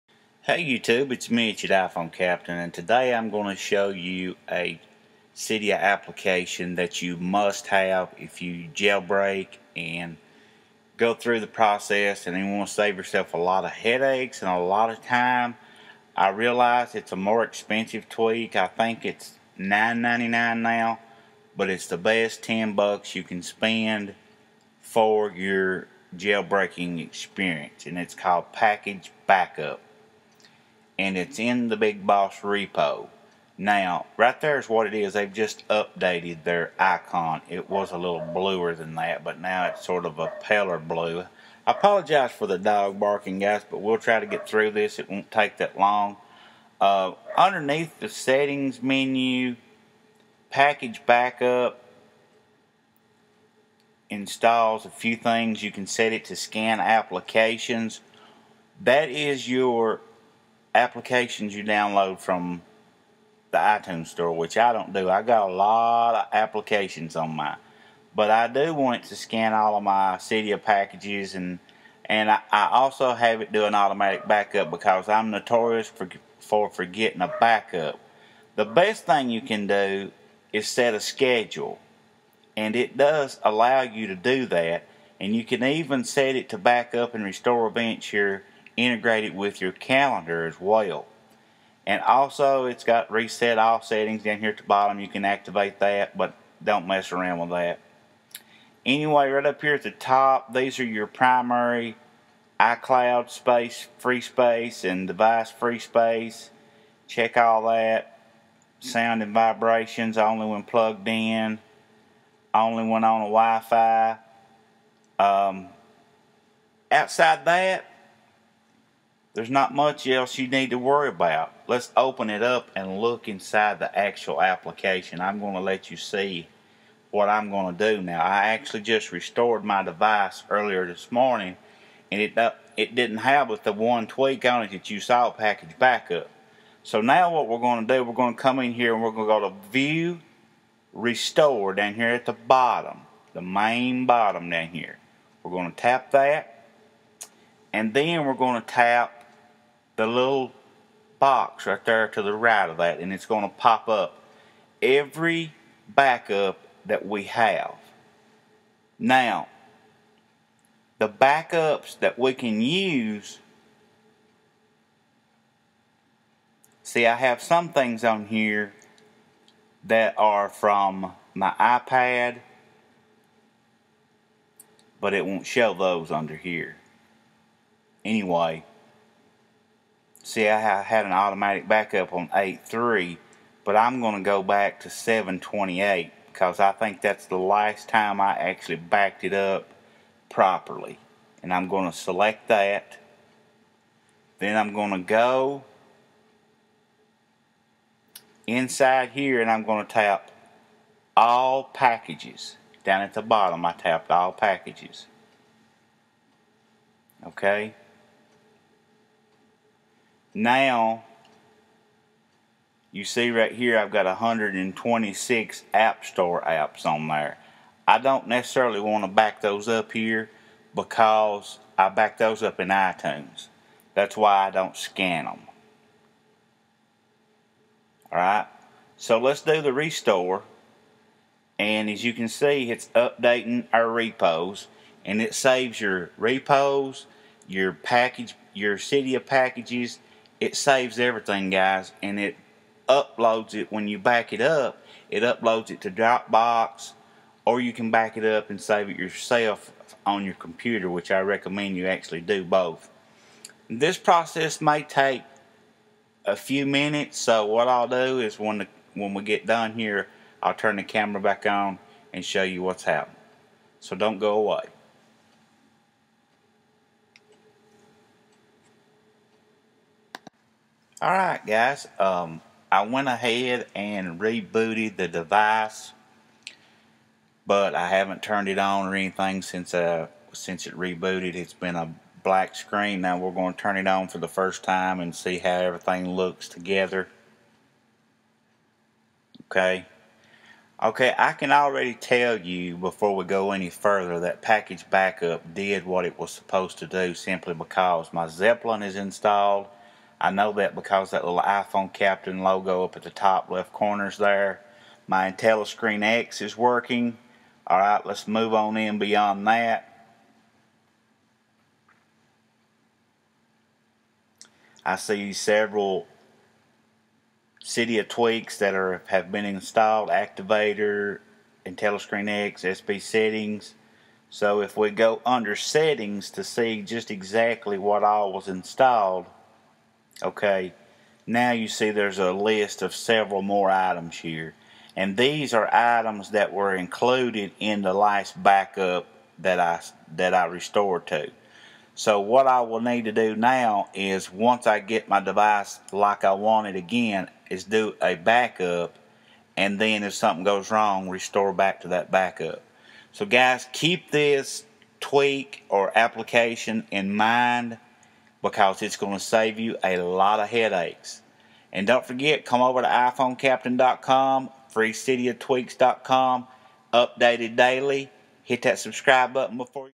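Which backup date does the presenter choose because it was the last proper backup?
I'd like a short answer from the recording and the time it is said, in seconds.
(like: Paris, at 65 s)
7.28, at 184 s.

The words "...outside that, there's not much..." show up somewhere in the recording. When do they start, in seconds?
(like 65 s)
116 s.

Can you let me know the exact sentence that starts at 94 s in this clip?
You can activate that, but don't mess around with that.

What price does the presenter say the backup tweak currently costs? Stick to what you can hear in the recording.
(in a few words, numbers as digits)
$9.99.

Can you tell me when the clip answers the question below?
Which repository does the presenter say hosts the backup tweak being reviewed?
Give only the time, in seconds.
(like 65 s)
31 s.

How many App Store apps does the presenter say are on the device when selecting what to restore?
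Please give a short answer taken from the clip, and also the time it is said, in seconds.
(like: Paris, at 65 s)
126, at 214 s.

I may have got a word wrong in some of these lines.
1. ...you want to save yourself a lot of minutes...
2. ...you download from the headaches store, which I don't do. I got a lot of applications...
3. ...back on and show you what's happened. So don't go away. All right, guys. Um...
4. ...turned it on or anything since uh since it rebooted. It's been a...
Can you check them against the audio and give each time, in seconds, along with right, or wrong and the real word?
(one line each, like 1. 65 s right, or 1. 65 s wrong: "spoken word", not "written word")
1. 12 s wrong: "headaches", not "minutes"
2. 61 s wrong: "iTunes", not "headaches"
3. 261 s right
4. 278 s right.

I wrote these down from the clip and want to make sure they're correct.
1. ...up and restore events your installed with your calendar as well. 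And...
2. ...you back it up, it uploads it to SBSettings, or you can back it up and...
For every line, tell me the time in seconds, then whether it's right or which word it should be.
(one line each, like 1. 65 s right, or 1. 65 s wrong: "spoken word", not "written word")
1. 86 s wrong: "integrated", not "installed"
2. 243 s wrong: "Dropbox", not "SBSettings".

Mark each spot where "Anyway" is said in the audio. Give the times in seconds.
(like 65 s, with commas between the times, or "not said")
98 s, 178 s.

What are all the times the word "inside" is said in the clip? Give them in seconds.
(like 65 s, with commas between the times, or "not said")
123 s, 198 s.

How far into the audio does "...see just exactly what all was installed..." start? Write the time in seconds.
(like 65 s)
326 s.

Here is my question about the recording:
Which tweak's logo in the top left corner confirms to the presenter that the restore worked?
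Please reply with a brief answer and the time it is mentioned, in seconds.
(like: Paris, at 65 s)
Zeppelin, at 298 s.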